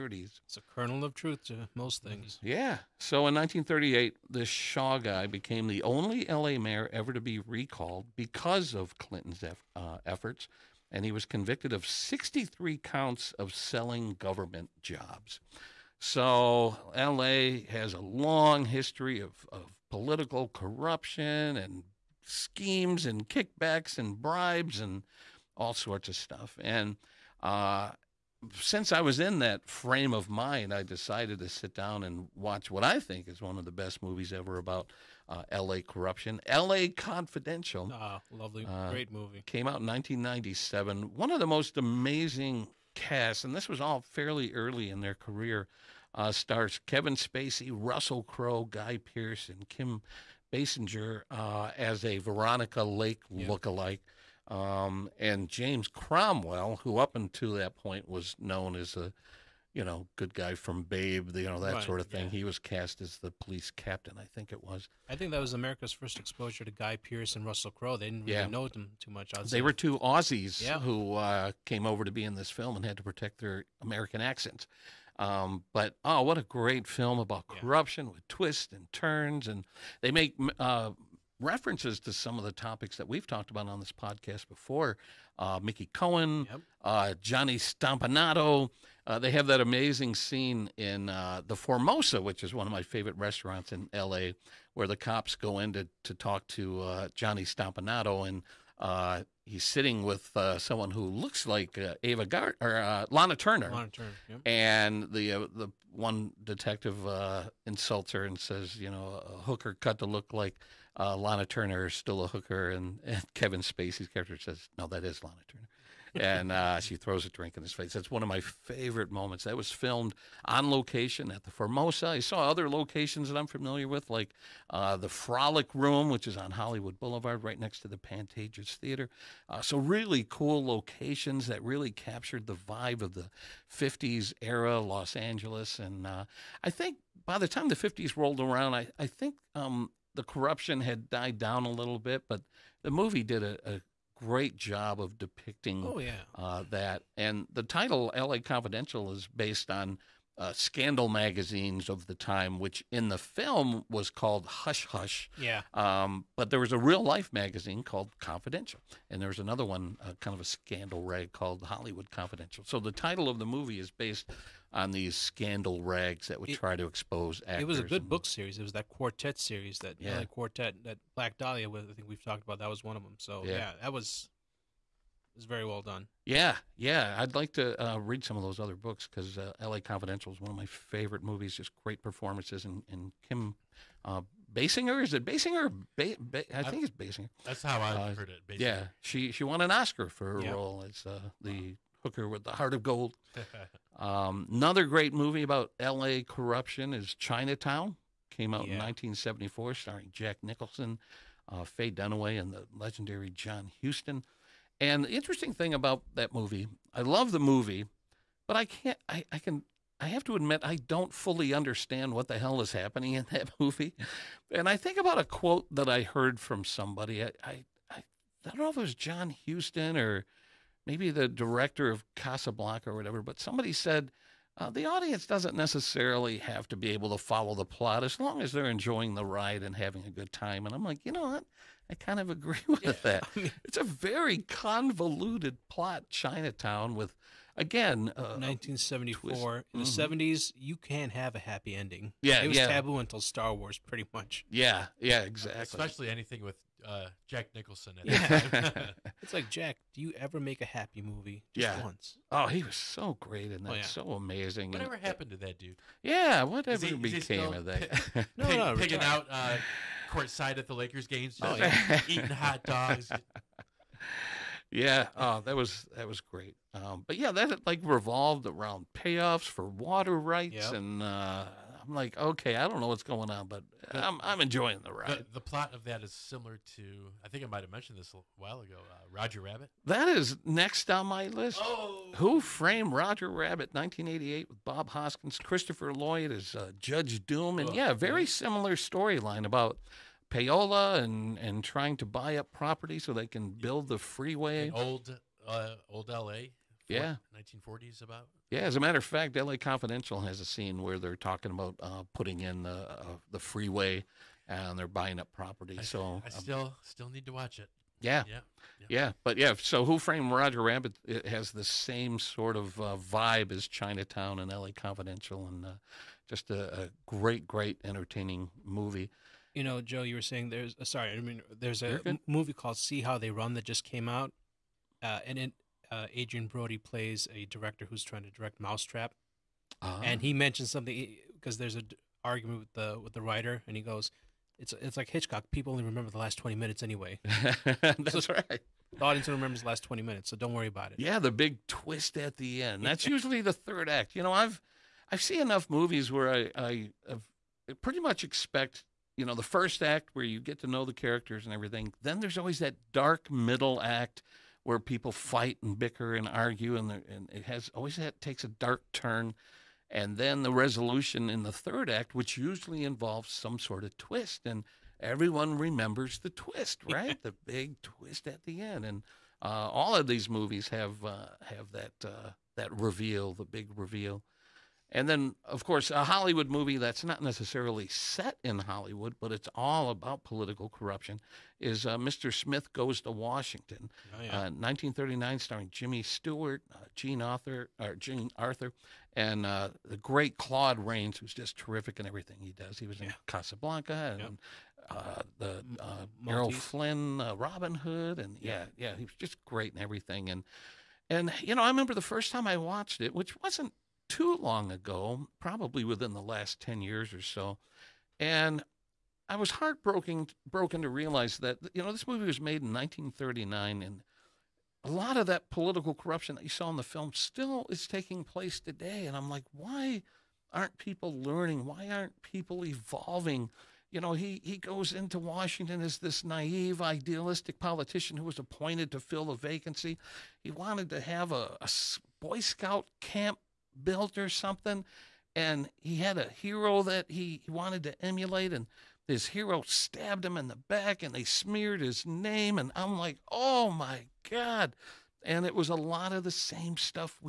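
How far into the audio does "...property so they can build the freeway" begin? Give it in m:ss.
4:52.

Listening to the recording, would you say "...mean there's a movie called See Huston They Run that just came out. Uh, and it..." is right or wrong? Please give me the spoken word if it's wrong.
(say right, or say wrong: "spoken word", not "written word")
wrong: "How", not "Huston".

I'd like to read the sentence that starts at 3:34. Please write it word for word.
And I think about a quote that I heard from somebody.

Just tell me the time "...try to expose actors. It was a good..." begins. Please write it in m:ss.
2:46.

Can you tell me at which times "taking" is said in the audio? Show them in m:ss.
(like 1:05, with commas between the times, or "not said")
6:57.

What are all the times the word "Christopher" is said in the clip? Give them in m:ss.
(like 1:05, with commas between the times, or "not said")
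4:45.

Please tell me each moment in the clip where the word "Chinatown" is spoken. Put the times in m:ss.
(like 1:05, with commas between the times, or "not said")
3:17, 3:56, 5:13.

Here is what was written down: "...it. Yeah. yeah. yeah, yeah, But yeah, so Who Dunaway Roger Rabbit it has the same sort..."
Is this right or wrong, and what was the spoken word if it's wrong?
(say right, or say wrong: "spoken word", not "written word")
wrong: "Framed", not "Dunaway".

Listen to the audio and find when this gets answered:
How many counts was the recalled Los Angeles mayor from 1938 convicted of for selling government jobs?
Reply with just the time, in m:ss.
0:11.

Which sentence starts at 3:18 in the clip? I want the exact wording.
in 1974, starring Jack Nicholson, uh, Faye Dunaway, and the legendary John Huston.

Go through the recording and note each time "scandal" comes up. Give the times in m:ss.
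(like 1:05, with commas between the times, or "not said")
2:30, 2:40, 2:45.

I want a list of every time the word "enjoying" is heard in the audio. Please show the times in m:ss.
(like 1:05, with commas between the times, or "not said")
3:48, 4:34.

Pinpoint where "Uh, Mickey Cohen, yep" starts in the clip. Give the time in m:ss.
1:25.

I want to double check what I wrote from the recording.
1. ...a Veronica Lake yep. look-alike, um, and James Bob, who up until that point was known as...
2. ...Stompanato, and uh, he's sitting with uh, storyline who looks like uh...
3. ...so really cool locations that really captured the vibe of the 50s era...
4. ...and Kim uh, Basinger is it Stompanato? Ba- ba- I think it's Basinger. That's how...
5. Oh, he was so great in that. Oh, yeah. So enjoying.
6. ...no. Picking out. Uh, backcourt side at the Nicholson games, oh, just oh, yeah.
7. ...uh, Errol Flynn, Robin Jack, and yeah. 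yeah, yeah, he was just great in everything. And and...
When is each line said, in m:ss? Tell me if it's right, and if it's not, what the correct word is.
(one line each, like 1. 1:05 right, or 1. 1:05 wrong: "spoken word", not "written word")
1. 0:52 wrong: "Cromwell", not "Bob"
2. 1:37 wrong: "someone", not "storyline"
3. 2:09 right
4. 3:02 wrong: "Basinger", not "Stompanato"
5. 4:12 wrong: "amazing", not "enjoying"
6. 4:18 wrong: "Lakers", not "Nicholson"
7. 6:35 wrong: "Hood", not "Jack".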